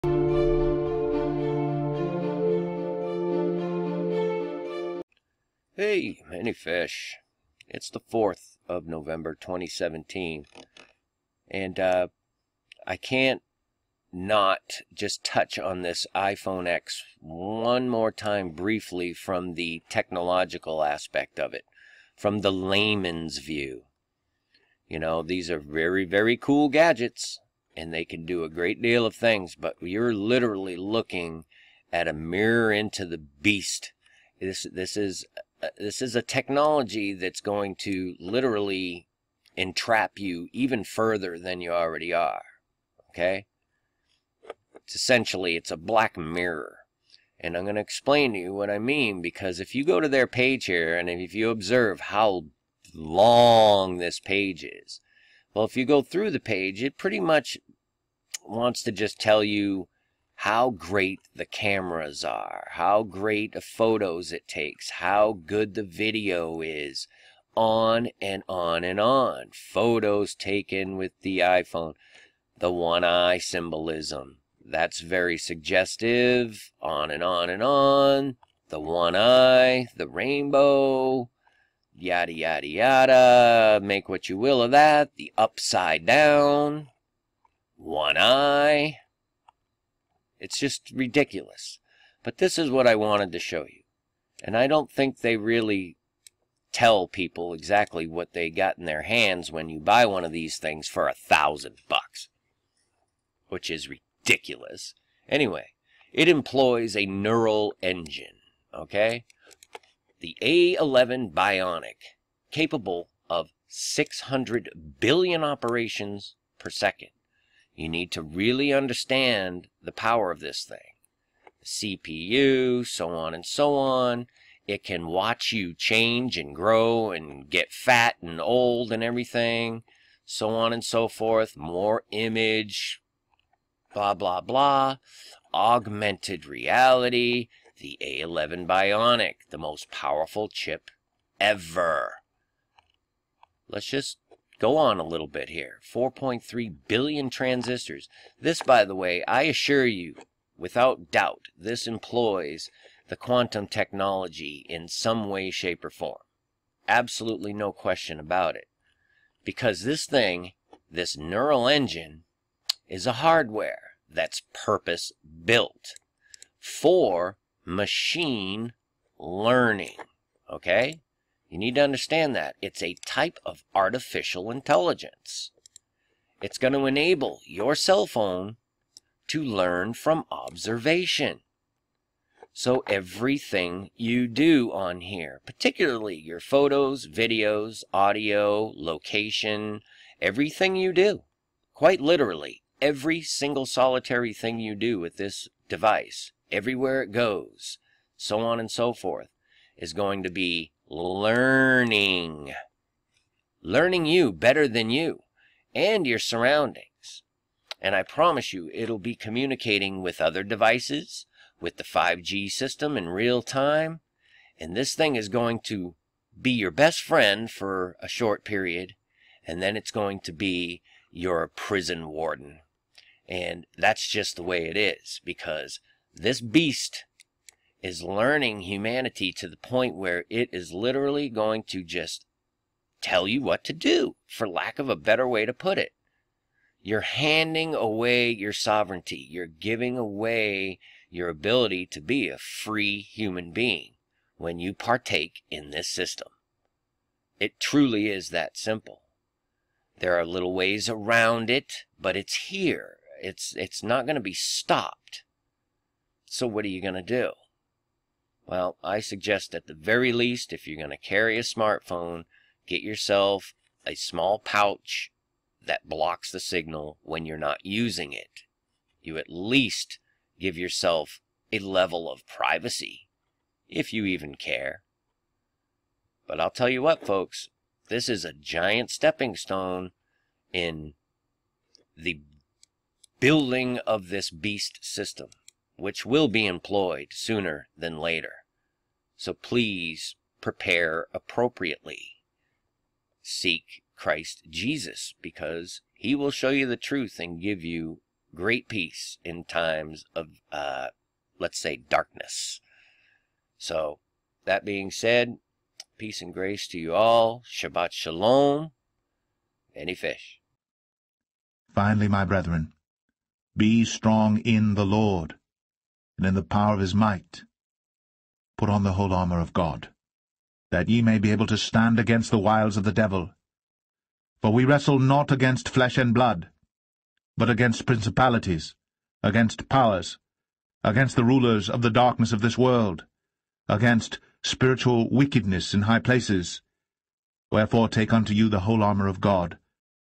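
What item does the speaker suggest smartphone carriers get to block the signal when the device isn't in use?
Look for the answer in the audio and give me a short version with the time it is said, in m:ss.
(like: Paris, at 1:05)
small pouch, at 4:23.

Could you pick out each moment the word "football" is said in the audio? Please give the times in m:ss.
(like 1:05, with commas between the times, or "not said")
not said.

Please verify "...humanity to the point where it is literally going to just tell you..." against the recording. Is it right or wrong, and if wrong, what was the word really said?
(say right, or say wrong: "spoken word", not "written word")
right.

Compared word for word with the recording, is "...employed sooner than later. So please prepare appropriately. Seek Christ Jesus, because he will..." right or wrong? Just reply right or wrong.
right.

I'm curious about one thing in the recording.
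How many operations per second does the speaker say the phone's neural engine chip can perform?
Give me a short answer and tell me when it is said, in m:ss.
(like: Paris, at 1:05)
600 billion, at 1:53.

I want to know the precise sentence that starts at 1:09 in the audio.
Photos taken with the iPhone, the one eye symbolism.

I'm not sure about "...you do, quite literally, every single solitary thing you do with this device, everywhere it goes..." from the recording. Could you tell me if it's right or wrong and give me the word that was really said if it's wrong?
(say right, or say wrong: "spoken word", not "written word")
right.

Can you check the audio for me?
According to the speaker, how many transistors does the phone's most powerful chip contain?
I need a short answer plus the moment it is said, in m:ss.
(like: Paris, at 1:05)
4.3 billion, at 2:25.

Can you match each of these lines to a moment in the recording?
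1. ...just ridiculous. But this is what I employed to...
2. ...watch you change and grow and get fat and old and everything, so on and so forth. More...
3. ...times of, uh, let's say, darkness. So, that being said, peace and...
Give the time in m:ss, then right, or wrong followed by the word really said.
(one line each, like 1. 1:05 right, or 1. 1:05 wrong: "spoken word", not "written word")
1. 1:30 wrong: "wanted", not "employed"
2. 2:05 right
3. 4:59 right.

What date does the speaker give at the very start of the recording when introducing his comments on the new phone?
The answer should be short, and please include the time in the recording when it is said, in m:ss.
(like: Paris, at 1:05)
4th of November 2017, at 0:08.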